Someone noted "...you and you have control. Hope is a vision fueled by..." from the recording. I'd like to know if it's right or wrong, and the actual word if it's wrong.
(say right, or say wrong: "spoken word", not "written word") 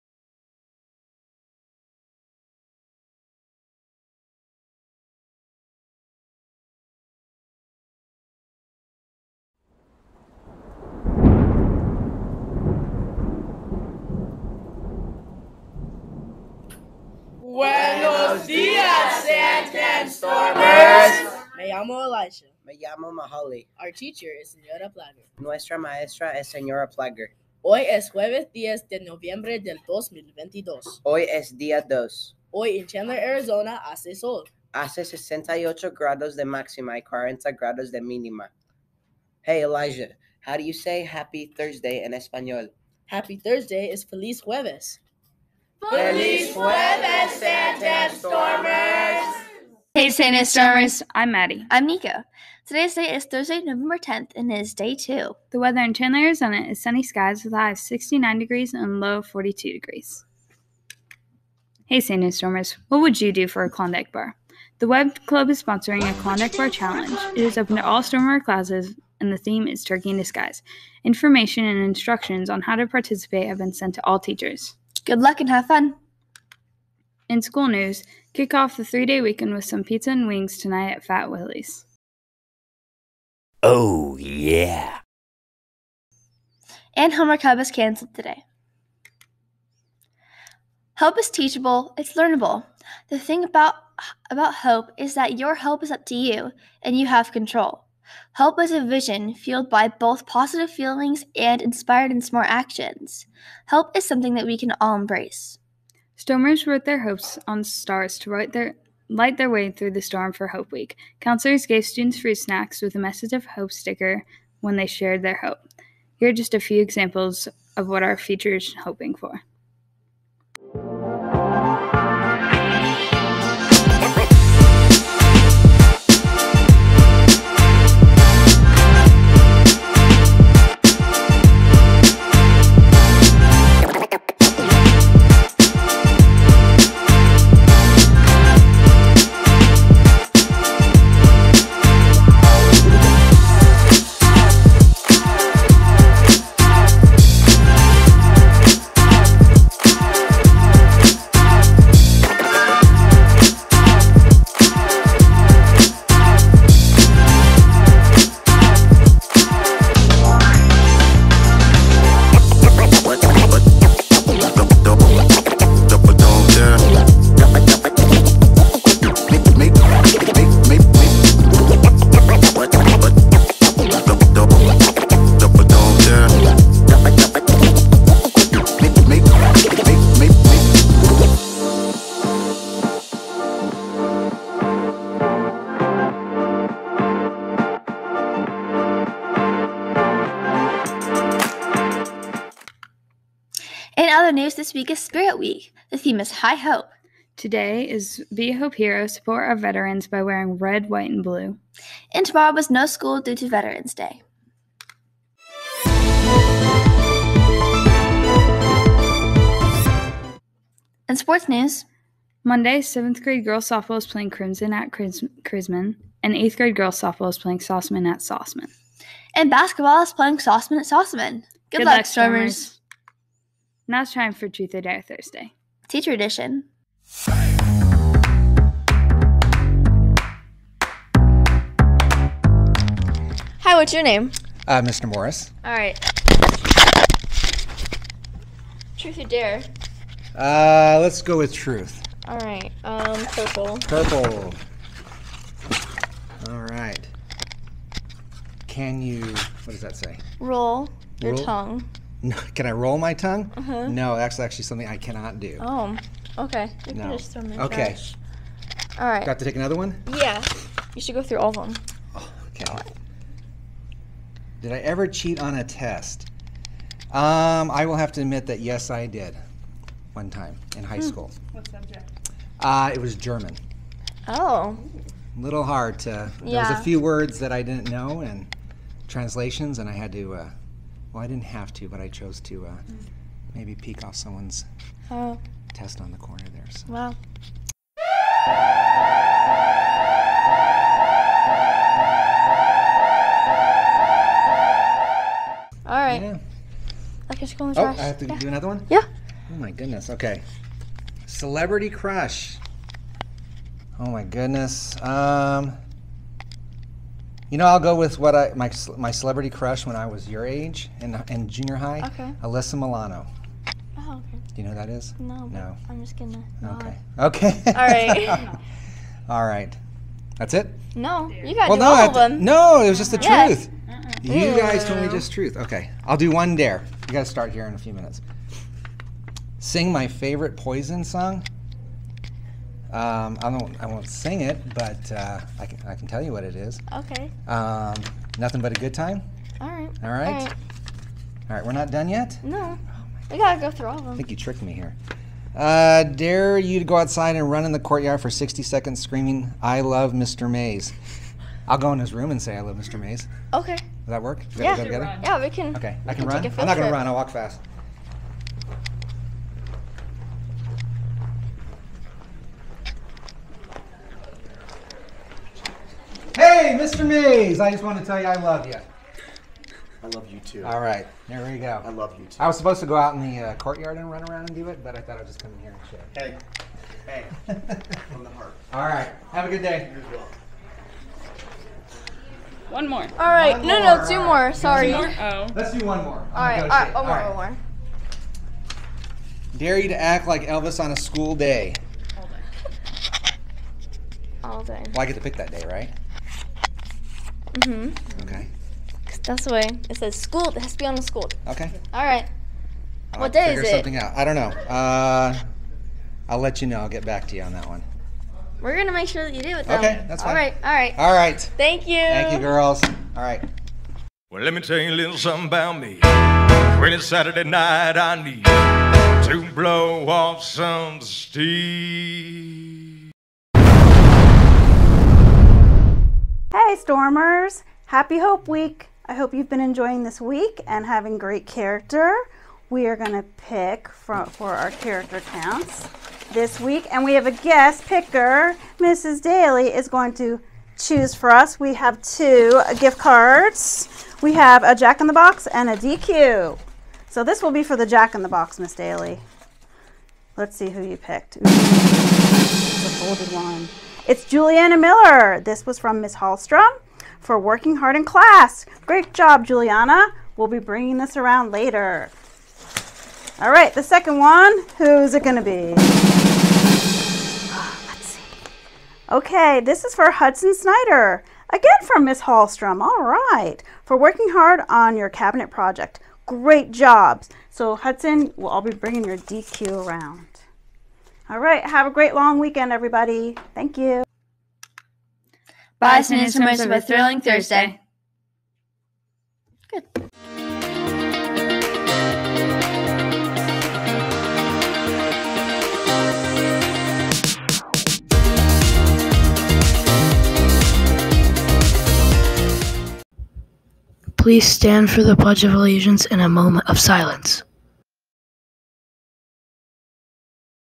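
right.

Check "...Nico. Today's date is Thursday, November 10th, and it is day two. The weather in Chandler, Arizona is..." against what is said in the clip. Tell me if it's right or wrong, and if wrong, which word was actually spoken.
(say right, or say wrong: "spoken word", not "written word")
right.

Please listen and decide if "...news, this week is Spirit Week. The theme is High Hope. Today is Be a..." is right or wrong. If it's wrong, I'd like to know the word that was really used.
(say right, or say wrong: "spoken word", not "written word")
right.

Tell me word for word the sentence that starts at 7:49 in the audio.
Okay, this is for Hudson Snyder.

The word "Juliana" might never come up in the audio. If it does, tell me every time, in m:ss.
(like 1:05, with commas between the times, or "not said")
7:34, 7:39.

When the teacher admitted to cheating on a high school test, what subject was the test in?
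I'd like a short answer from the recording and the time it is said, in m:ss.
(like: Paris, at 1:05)
German, at 4:33.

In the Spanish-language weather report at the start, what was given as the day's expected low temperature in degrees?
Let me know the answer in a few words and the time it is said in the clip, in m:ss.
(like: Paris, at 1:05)
40, at 0:37.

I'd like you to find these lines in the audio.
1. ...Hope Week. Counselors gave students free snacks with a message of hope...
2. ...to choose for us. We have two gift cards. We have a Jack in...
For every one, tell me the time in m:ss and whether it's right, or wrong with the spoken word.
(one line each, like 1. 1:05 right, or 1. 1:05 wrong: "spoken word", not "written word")
1. 1:50 right
2. 7:20 right.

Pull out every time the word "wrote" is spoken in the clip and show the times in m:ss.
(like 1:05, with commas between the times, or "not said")
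1:46.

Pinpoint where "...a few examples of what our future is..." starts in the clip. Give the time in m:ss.
1:56.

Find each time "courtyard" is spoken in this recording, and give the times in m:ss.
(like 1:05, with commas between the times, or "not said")
5:47, 6:13.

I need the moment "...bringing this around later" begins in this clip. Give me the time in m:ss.
7:40.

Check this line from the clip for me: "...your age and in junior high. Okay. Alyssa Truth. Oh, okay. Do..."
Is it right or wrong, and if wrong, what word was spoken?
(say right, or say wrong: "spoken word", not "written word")
wrong: "Milano", not "Truth".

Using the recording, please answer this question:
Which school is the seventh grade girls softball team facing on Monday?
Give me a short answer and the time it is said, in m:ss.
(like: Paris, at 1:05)
Crimson, at 3:34.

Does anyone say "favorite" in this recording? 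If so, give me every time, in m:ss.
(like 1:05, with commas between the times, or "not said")
5:30.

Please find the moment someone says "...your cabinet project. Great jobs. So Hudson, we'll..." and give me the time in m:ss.
7:54.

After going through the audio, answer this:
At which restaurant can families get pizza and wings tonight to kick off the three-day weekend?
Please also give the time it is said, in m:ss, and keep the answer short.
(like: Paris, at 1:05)
Fat Willie's, at 1:21.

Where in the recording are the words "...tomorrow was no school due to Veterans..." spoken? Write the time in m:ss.
3:22.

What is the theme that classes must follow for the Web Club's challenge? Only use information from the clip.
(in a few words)
Turkey in Disguise.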